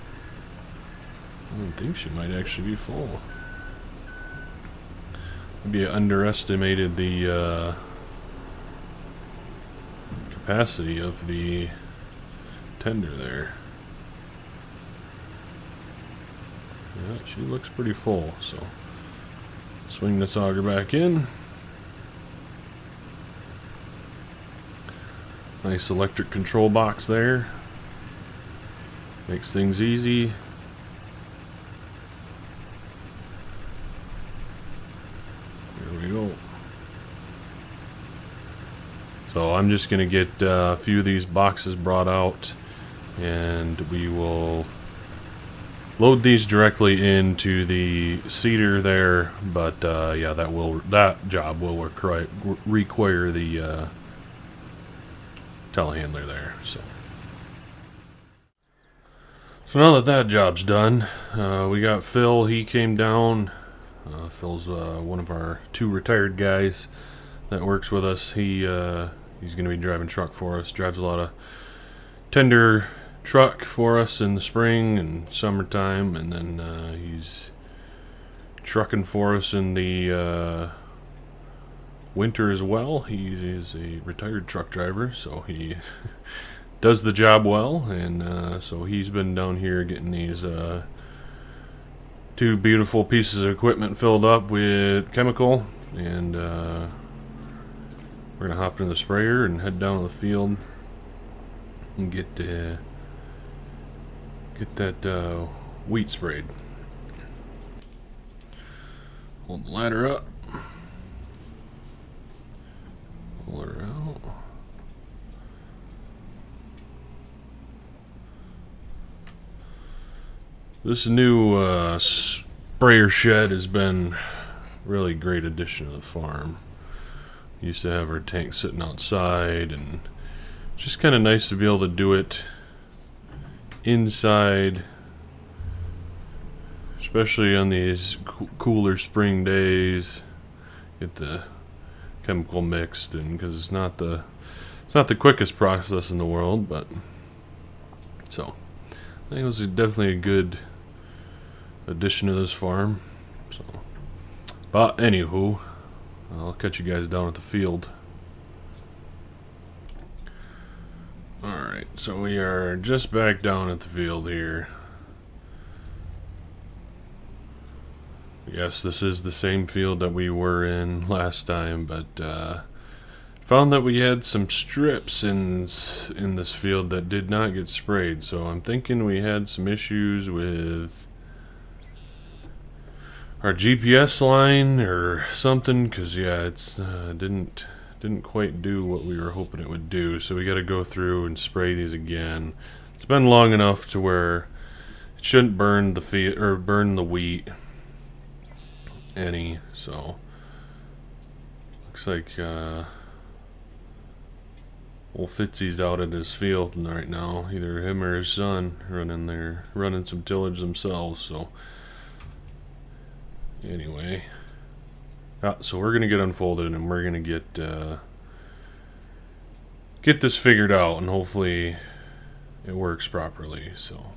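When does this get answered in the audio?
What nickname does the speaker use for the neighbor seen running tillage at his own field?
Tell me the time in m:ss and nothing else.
3:25.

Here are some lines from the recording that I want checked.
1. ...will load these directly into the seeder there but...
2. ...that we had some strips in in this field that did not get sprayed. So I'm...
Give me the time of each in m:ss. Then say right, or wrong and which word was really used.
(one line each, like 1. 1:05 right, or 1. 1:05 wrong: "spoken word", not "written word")
1. 0:44 right
2. 2:53 right.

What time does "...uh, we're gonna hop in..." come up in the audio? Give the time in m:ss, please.
1:36.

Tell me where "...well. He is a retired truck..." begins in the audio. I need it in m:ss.
1:22.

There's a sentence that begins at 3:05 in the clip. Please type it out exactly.
Cause yeah, it's uh, didn't didn't quite do what we were hoping it would do.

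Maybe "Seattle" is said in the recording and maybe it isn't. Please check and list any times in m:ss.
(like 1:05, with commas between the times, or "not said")
not said.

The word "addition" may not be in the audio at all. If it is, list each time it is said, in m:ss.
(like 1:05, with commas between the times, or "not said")
2:05, 2:31.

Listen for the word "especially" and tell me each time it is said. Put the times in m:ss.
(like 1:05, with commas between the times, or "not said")
2:16.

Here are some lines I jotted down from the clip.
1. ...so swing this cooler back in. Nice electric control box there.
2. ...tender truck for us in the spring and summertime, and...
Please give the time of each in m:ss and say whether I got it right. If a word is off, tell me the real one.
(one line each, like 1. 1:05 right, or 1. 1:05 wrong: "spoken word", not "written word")
1. 0:18 wrong: "auger", not "cooler"
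2. 1:12 right.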